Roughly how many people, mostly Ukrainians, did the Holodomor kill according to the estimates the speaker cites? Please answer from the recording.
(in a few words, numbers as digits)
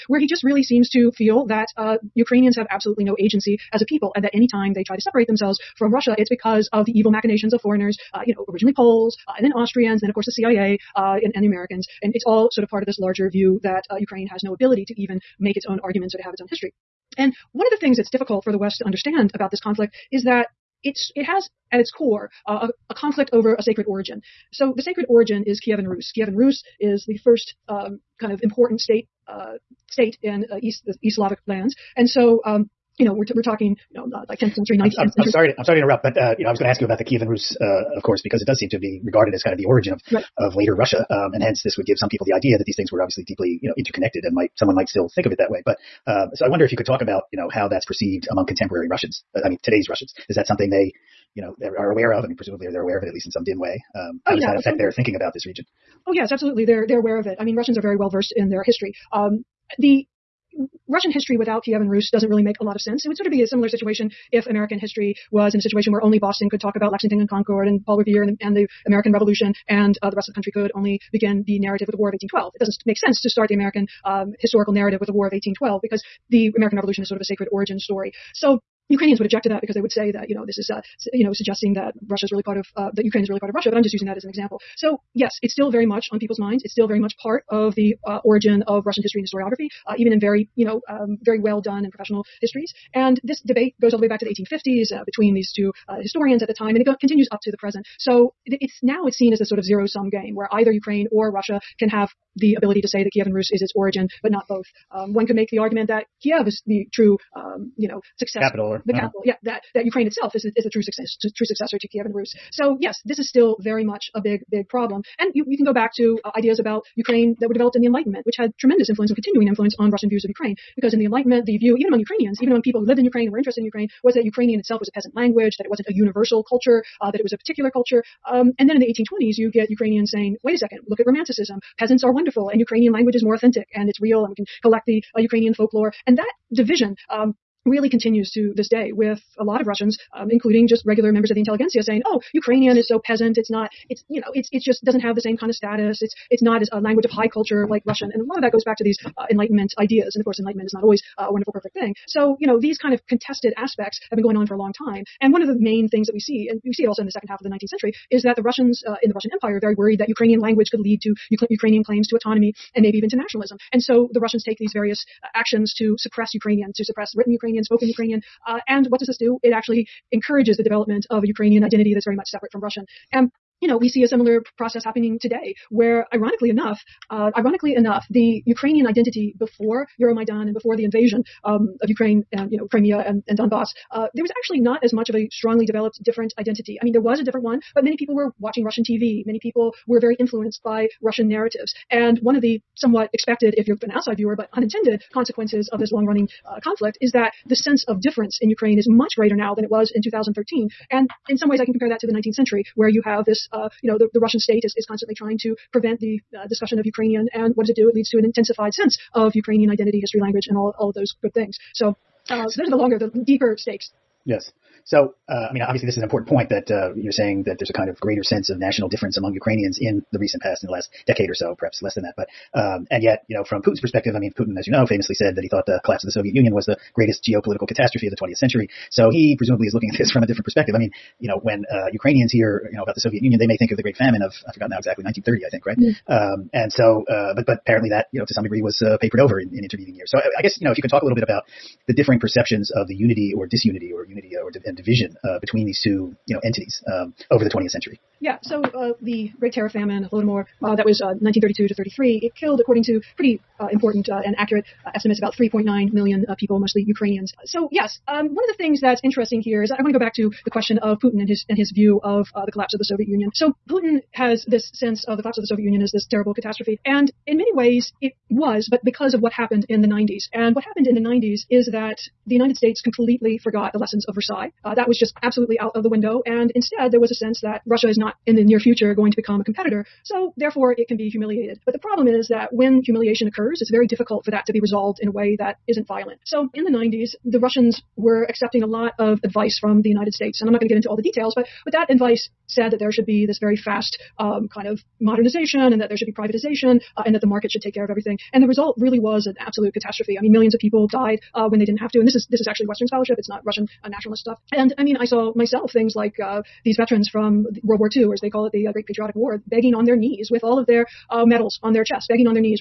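3.9 million.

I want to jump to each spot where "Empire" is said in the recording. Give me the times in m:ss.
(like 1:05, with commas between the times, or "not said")
2:39.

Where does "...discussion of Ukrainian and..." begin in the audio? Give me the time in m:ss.
3:26.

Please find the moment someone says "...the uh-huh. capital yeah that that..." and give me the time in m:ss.
1:48.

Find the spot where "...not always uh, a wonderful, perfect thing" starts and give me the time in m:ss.
2:30.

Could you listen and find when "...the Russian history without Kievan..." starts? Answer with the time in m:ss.
0:59.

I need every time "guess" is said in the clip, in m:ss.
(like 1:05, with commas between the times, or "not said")
4:00.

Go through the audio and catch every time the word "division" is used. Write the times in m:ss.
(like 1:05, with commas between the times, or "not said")
2:16, 4:04.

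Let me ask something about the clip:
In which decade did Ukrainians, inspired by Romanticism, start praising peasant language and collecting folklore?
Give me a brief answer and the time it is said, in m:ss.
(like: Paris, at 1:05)
1820s, at 2:08.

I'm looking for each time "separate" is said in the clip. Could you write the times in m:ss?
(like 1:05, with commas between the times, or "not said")
0:05, 2:52.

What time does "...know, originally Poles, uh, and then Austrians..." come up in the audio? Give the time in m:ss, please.
0:08.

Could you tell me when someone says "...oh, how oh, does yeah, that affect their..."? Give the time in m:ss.
0:54.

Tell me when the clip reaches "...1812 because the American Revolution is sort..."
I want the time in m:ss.
1:15.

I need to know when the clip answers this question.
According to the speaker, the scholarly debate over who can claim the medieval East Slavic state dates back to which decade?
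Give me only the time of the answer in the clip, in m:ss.
1:34.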